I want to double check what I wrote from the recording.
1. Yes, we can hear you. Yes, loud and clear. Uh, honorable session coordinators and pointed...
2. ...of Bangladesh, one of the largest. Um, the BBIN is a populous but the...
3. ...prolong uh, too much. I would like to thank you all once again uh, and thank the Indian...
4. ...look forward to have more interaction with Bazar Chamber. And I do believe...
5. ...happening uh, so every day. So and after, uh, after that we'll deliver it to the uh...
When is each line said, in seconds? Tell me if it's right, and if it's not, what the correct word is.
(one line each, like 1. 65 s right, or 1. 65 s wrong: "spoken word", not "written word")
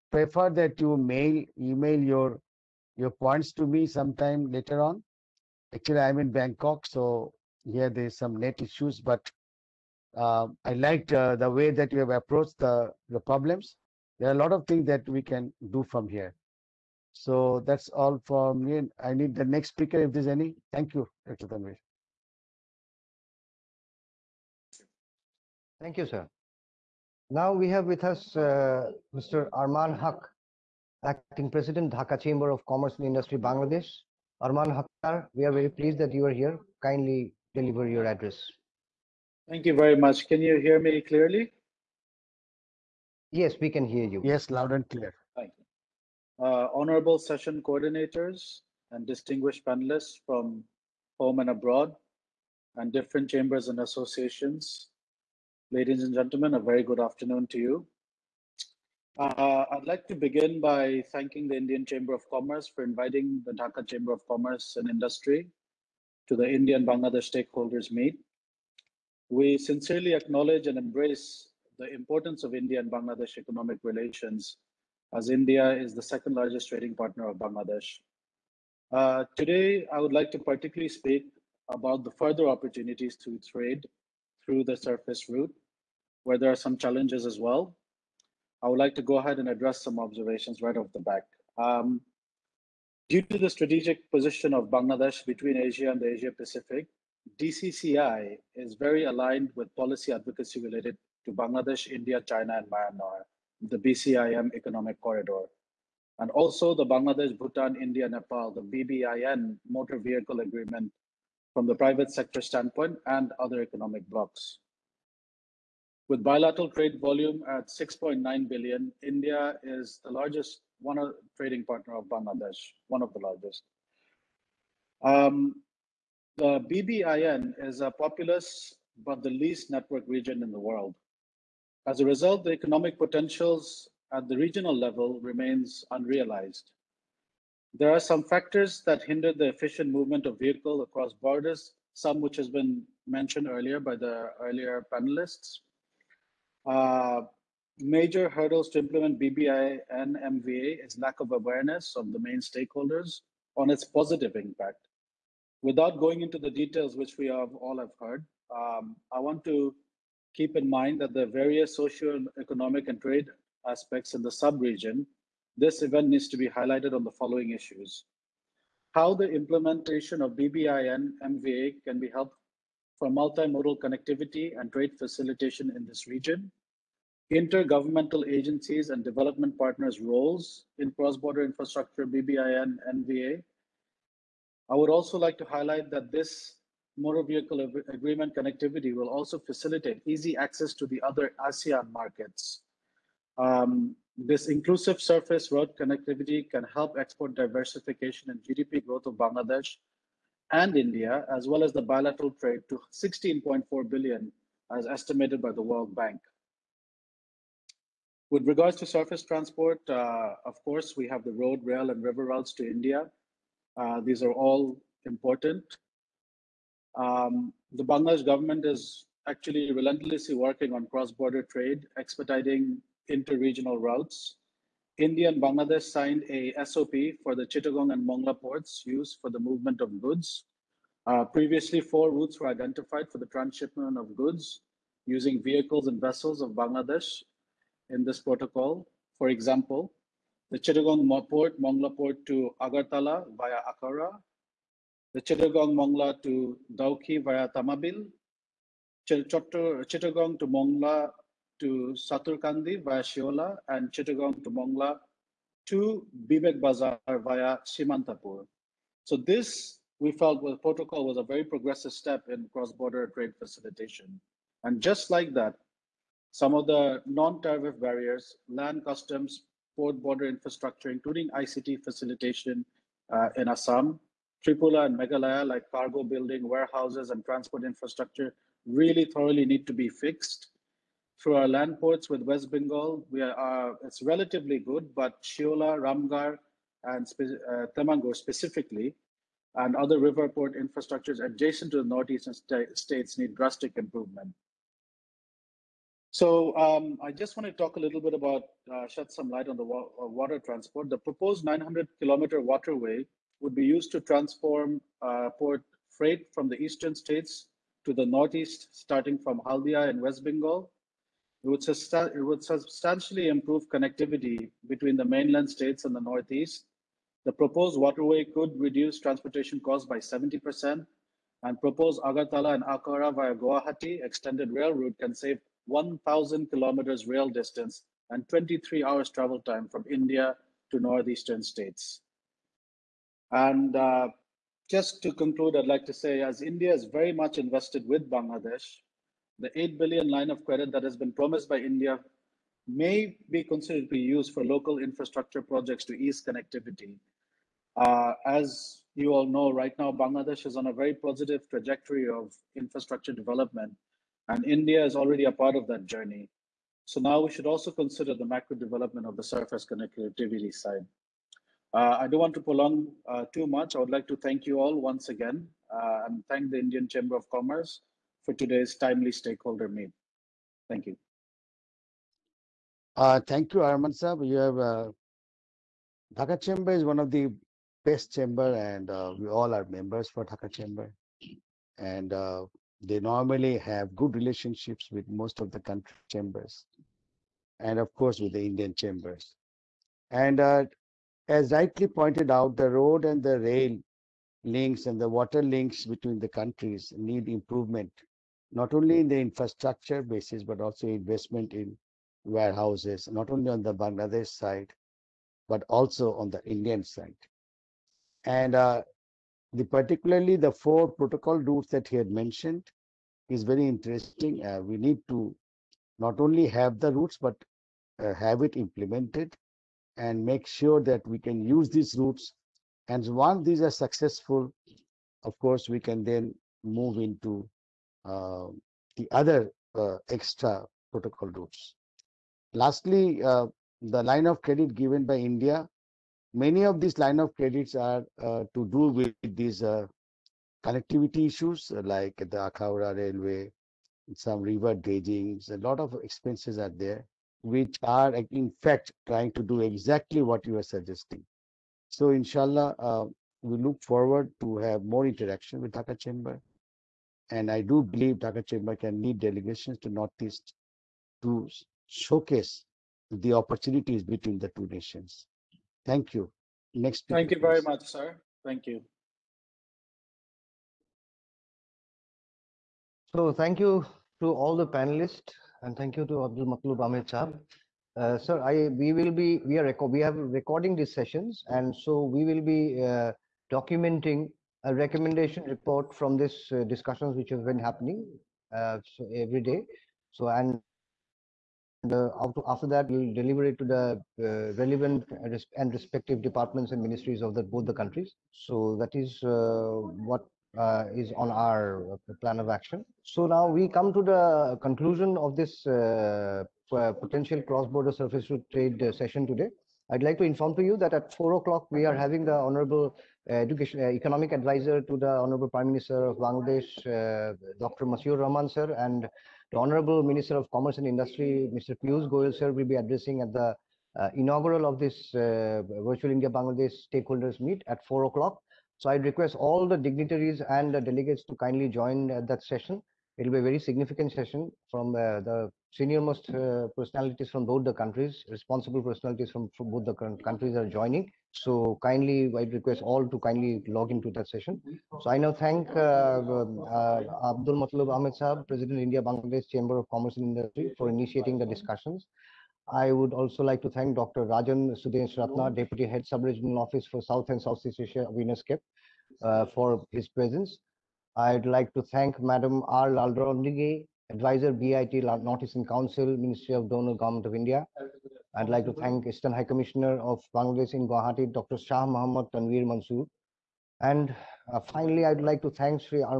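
1. 43 s wrong: "distinguished", not "pointed"
2. 121 s right
3. 362 s right
4. 453 s wrong: "Dhaka", not "Bazar"
5. 487 s right.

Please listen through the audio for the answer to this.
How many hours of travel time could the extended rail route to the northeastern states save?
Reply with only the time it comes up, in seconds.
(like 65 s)
328 s.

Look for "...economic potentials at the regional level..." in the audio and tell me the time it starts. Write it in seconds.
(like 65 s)
132 s.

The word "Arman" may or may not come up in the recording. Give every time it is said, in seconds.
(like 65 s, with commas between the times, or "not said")
29 s, 34 s, 373 s.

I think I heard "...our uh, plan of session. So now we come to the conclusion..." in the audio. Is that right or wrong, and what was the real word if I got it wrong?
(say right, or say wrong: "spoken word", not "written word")
wrong: "action", not "session".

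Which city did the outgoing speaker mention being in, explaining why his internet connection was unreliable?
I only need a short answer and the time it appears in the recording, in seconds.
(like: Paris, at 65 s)
Bangkok, at 6 s.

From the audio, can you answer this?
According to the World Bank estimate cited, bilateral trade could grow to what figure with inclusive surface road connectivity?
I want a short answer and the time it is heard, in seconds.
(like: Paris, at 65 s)
16.4 billion, at 202 s.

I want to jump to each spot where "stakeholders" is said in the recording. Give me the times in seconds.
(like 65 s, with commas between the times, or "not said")
67 s, 152 s, 369 s, 526 s.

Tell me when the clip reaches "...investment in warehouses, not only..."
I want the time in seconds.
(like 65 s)
400 s.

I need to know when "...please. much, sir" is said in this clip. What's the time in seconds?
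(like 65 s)
467 s.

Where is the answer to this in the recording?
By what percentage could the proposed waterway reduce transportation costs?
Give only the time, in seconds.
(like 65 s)
319 s.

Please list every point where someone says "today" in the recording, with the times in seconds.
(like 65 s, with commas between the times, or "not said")
79 s, 368 s, 509 s.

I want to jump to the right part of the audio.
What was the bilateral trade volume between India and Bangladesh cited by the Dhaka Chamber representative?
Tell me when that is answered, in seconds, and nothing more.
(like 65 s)
117 s.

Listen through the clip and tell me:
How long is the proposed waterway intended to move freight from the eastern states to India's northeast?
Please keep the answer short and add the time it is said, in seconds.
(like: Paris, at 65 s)
900 kilometers, at 301 s.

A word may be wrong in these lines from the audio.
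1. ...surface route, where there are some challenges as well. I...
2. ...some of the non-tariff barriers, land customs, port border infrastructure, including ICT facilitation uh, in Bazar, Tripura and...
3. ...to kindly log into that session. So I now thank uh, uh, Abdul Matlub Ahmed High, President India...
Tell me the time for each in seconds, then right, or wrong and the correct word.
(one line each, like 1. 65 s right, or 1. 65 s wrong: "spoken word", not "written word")
1. 84 s right
2. 266 s wrong: "Assam", not "Bazar"
3. 543 s wrong: "Saab", not "High".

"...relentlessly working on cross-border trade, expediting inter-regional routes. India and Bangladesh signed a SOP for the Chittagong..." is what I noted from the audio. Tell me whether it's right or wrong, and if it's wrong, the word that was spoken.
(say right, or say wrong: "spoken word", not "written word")
right.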